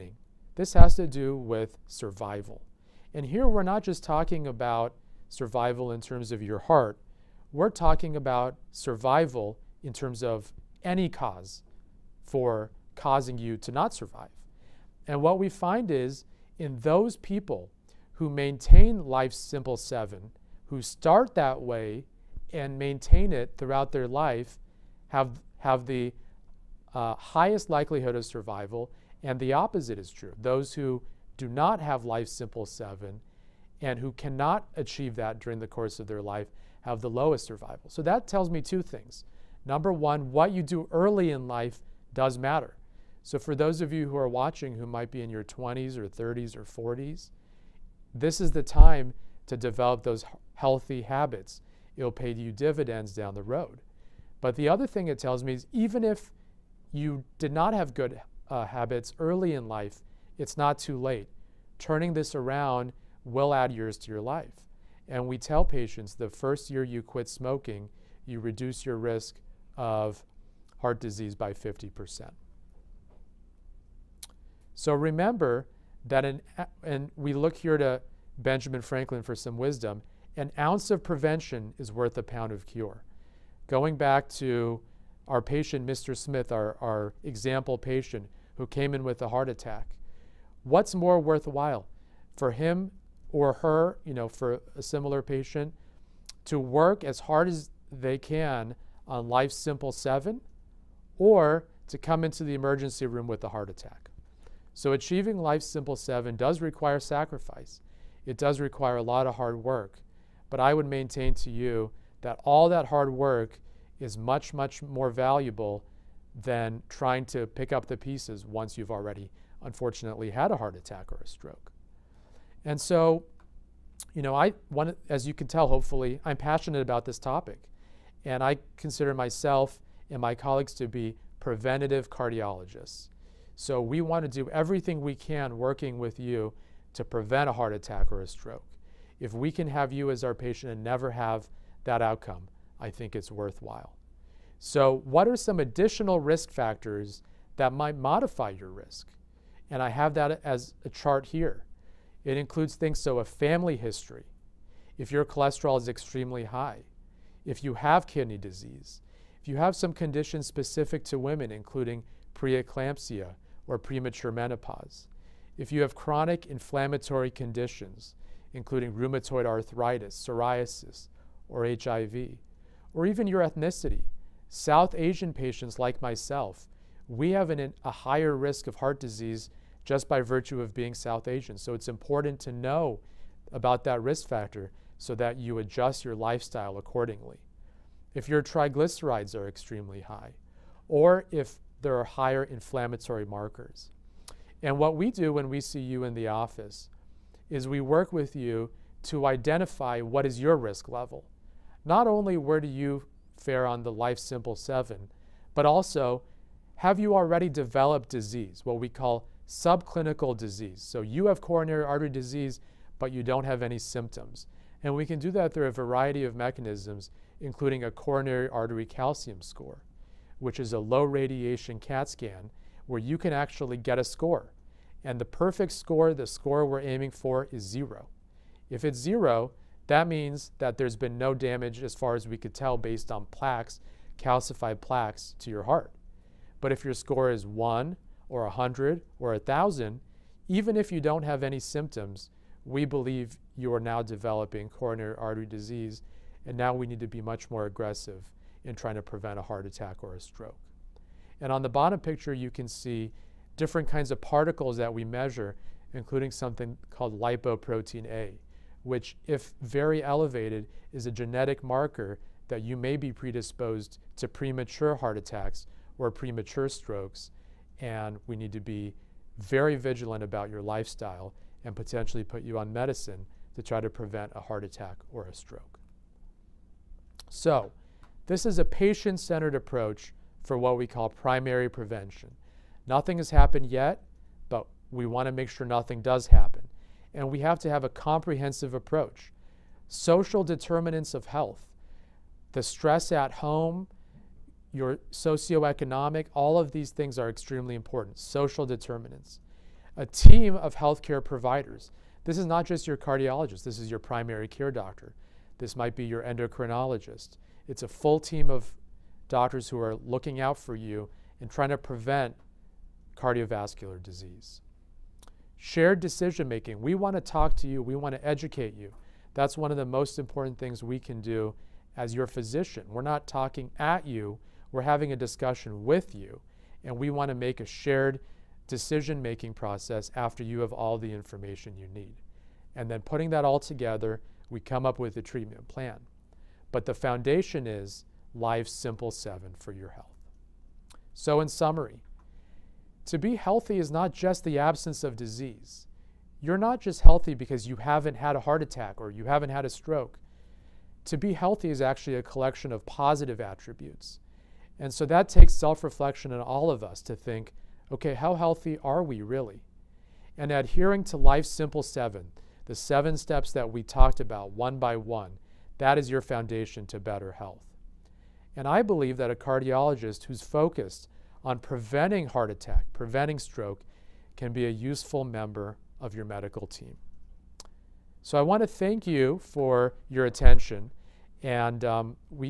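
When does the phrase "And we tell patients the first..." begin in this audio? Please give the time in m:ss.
1:05.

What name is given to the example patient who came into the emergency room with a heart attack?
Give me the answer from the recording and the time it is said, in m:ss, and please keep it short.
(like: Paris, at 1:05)
Mr. Smith, at 1:25.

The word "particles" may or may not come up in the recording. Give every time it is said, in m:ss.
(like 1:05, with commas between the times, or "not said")
4:14.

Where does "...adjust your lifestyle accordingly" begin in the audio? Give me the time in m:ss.
3:05.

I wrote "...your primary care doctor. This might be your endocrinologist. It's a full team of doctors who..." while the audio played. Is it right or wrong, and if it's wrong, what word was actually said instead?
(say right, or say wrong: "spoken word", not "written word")
right.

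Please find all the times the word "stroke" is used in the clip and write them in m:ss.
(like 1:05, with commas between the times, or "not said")
2:01, 2:18, 4:10, 4:26, 4:35, 5:49, 6:13.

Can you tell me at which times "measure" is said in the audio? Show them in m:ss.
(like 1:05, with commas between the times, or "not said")
4:15.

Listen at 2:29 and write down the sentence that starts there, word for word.
And I have that as a chart here.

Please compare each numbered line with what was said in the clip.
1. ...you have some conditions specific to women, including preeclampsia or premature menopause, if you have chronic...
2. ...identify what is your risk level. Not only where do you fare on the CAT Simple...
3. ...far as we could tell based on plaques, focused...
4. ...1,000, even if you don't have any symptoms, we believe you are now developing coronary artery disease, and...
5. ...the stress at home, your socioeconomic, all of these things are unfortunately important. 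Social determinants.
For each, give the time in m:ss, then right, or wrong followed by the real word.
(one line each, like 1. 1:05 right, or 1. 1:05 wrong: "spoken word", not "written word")
1. 2:39 right
2. 3:19 wrong: "Life", not "CAT"
3. 3:51 wrong: "calcified", not "focused"
4. 3:59 right
5. 4:52 wrong: "extremely", not "unfortunately".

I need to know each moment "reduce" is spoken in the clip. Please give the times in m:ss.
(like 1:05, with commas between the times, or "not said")
1:08.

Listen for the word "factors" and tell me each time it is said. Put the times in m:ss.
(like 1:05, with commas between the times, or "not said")
2:26, 3:04.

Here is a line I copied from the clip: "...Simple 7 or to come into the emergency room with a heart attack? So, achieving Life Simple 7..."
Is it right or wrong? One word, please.
right.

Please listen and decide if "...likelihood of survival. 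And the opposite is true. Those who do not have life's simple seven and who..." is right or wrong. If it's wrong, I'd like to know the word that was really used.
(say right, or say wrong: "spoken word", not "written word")
right.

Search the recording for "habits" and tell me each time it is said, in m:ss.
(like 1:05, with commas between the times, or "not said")
0:51, 0:58.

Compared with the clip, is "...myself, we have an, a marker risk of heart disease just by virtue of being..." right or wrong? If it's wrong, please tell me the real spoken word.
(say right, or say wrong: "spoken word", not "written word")
wrong: "higher", not "marker".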